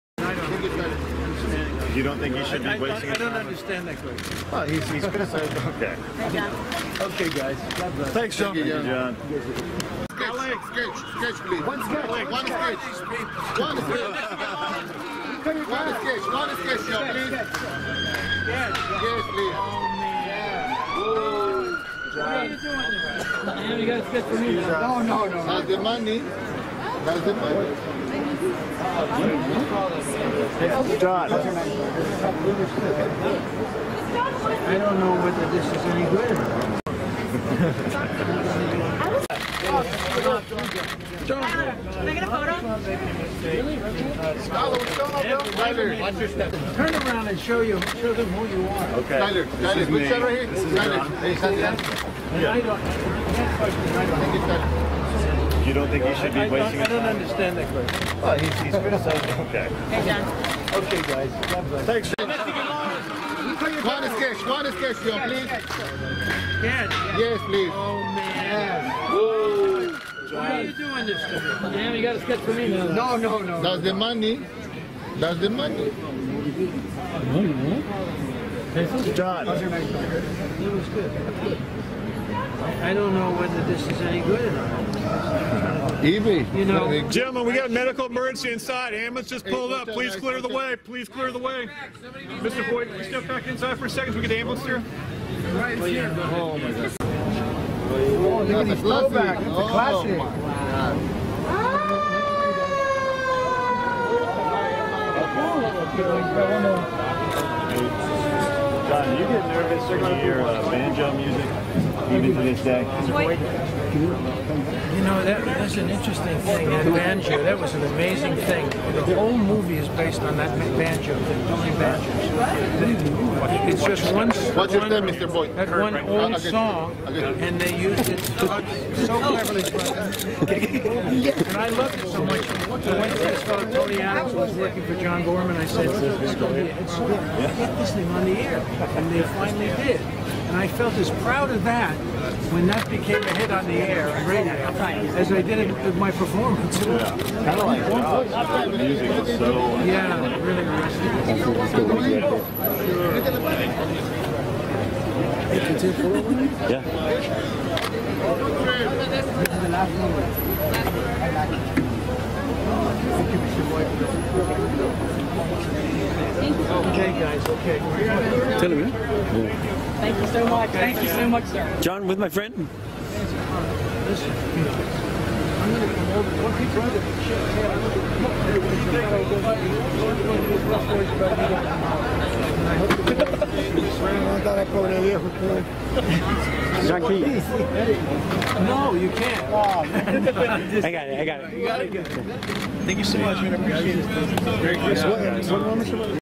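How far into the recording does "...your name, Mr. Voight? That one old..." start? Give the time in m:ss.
2:04.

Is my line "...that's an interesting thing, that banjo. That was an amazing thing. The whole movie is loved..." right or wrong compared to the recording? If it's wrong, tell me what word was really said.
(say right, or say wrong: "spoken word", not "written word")
wrong: "based", not "loved".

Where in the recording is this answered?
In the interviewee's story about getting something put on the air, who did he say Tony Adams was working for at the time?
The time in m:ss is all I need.
2:15.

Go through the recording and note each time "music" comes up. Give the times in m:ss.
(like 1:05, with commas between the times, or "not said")
1:51, 2:28.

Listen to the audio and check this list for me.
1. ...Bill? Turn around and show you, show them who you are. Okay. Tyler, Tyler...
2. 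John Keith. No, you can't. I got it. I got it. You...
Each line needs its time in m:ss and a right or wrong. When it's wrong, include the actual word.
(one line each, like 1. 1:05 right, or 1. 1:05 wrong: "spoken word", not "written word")
1. 0:46 right
2. 3:06 right.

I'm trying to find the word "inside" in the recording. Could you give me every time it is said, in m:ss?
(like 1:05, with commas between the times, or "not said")
1:28, 1:33.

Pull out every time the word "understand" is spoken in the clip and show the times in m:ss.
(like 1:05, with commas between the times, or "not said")
0:03, 0:57.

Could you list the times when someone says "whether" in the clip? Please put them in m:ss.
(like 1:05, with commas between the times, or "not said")
0:35, 1:23.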